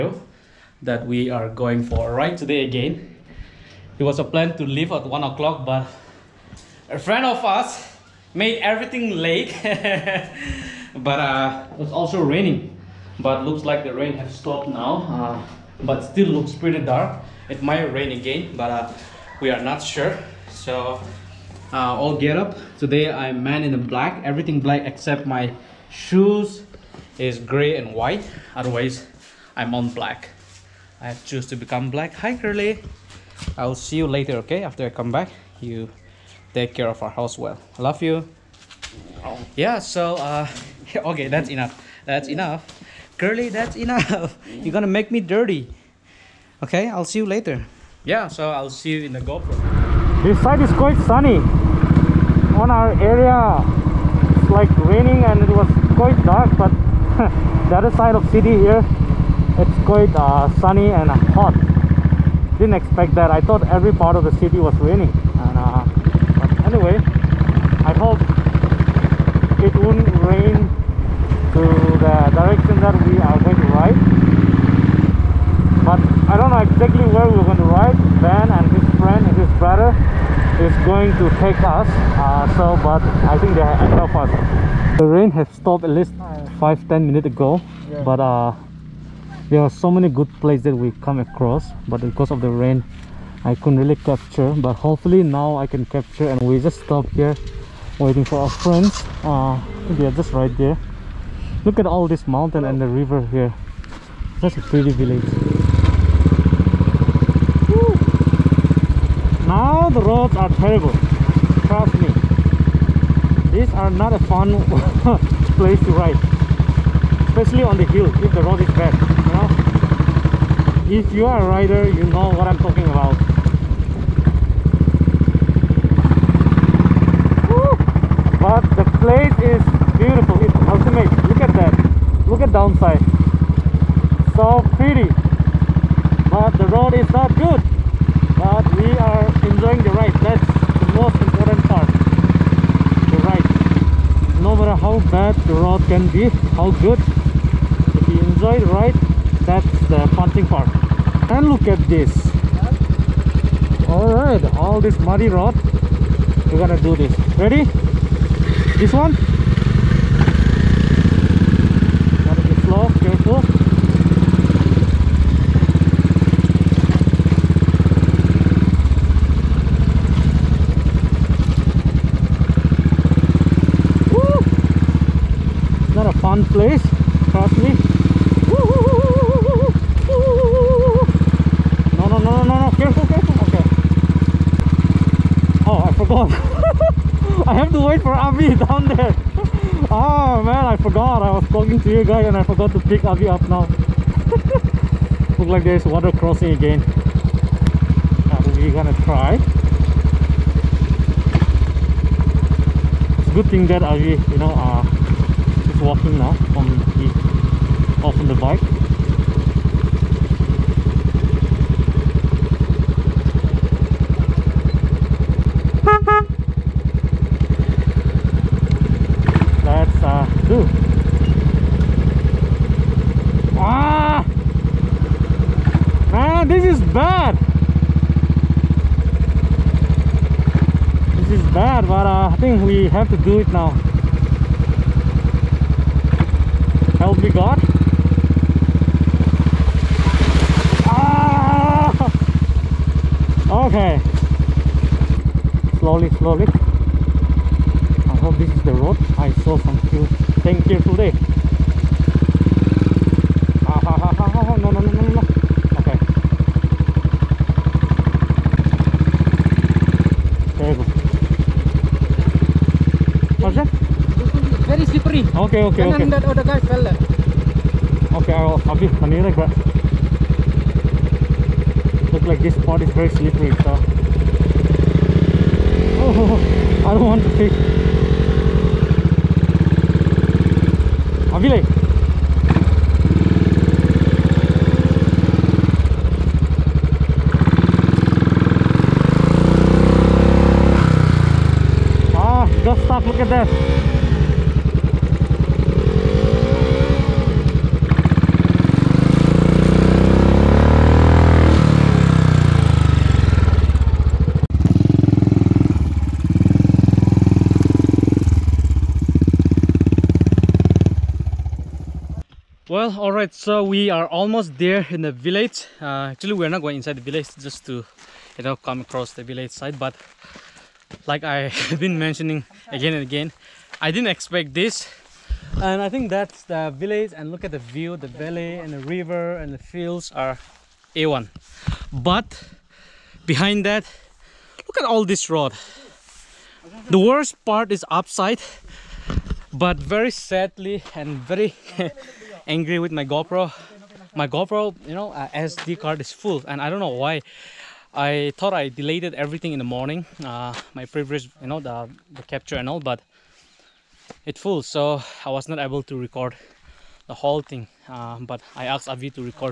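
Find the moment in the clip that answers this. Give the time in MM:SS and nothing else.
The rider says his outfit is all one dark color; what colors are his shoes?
00:27.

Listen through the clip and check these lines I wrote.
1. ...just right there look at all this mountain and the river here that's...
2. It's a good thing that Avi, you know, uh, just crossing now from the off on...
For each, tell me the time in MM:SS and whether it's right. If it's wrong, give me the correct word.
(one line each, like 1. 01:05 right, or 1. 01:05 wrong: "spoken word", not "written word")
1. 01:40 right
2. 03:19 wrong: "walking", not "crossing".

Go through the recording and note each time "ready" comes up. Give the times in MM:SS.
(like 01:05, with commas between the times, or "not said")
02:37.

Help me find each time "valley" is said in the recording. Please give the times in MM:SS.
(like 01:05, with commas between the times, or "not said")
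05:28.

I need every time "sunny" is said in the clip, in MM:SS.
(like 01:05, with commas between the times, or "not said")
00:51, 01:00.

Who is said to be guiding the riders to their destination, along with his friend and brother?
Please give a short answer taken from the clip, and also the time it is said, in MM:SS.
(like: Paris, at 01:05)
Ben, at 01:18.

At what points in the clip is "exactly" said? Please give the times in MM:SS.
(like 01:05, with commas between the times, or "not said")
01:16.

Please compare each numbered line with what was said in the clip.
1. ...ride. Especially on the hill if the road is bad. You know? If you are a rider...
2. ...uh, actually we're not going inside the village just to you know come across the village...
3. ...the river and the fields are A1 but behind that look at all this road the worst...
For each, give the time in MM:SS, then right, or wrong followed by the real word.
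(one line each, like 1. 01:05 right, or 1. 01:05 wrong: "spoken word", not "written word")
1. 01:55 right
2. 05:15 right
3. 05:28 right.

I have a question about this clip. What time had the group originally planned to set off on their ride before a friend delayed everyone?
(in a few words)
1 o'clock.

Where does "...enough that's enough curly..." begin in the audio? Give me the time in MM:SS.
00:41.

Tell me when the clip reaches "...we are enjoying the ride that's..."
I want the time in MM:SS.
02:18.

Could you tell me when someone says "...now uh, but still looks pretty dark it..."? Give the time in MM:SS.
00:14.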